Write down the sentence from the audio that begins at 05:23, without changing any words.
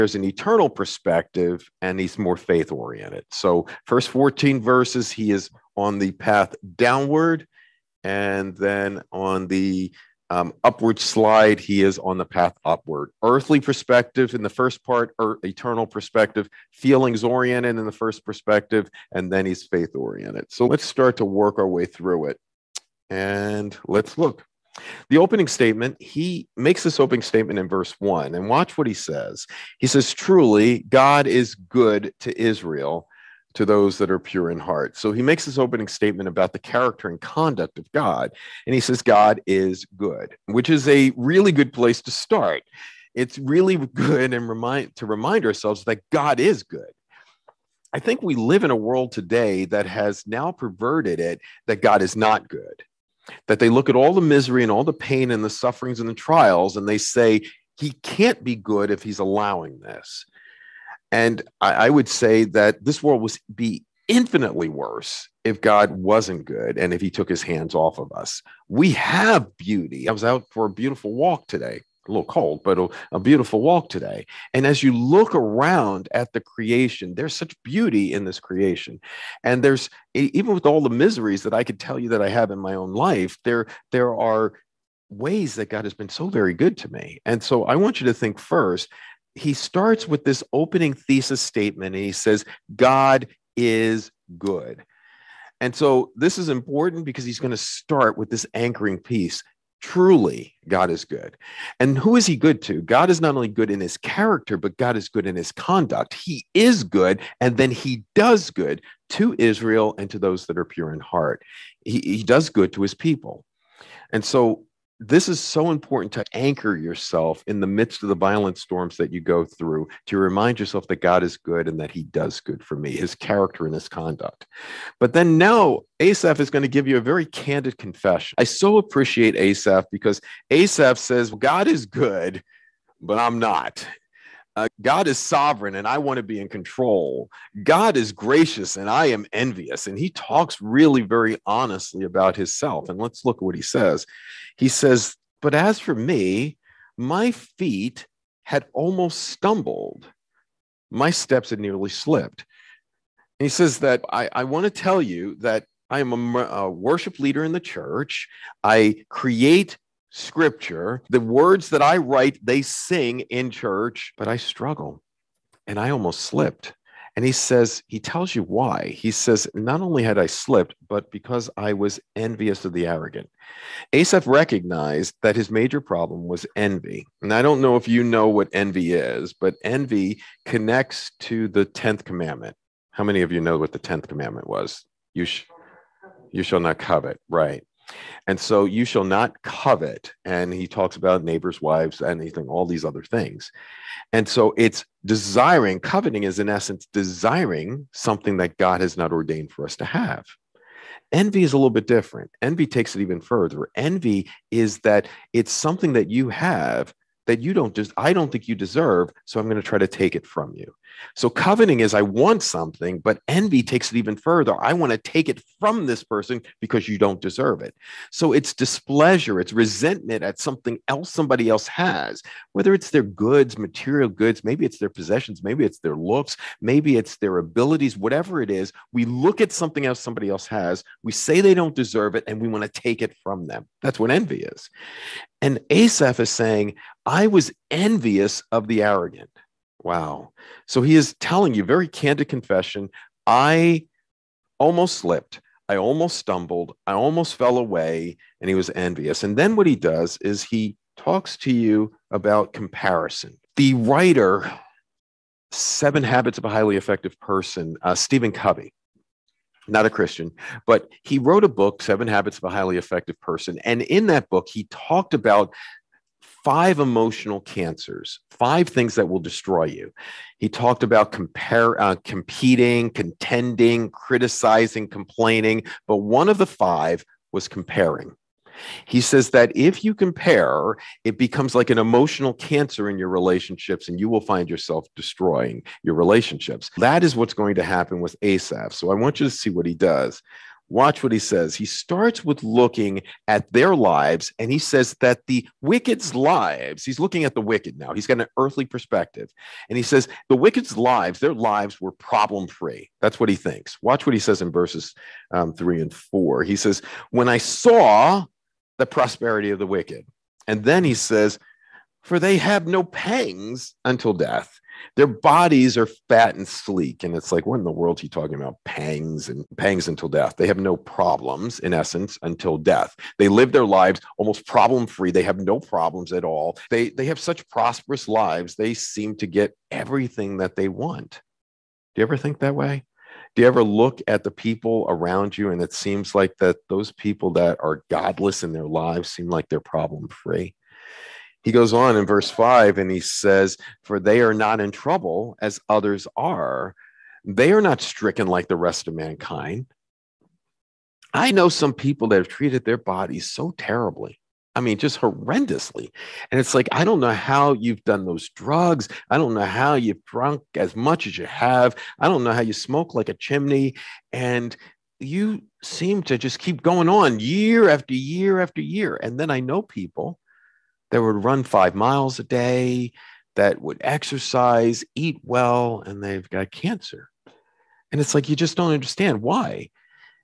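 They live their lives almost problem free.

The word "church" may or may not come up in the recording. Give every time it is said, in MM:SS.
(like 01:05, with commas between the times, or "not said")
02:37, 02:43.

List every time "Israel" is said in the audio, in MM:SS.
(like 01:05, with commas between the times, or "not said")
00:32, 01:49.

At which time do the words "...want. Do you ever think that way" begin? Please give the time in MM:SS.
05:30.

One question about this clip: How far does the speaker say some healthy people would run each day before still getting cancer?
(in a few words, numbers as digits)
5 miles.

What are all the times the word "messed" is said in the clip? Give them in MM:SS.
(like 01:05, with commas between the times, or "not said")
not said.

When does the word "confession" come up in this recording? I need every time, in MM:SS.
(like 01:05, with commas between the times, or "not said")
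02:07, 04:02.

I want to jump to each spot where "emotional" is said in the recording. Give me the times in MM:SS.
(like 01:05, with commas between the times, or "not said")
04:26, 04:41.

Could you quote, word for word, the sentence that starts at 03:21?
Envy is a little bit different.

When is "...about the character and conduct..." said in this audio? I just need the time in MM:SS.
00:36.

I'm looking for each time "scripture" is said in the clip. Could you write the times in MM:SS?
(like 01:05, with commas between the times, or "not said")
02:40.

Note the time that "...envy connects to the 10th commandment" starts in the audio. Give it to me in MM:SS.
02:59.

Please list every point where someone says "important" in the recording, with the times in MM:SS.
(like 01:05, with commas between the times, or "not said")
01:36, 01:55.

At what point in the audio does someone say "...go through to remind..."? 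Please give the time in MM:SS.
01:59.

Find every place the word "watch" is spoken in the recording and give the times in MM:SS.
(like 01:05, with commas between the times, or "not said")
00:28, 04:50, 05:03.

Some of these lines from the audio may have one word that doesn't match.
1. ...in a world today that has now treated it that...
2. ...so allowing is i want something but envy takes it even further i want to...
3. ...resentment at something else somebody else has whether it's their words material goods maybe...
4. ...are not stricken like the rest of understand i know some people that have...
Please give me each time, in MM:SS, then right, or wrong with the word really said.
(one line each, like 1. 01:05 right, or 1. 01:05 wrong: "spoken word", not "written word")
1. 00:48 wrong: "perverted", not "treated"
2. 03:31 wrong: "coveting", not "allowing"
3. 03:39 wrong: "goods", not "words"
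4. 05:47 wrong: "mankind", not "understand".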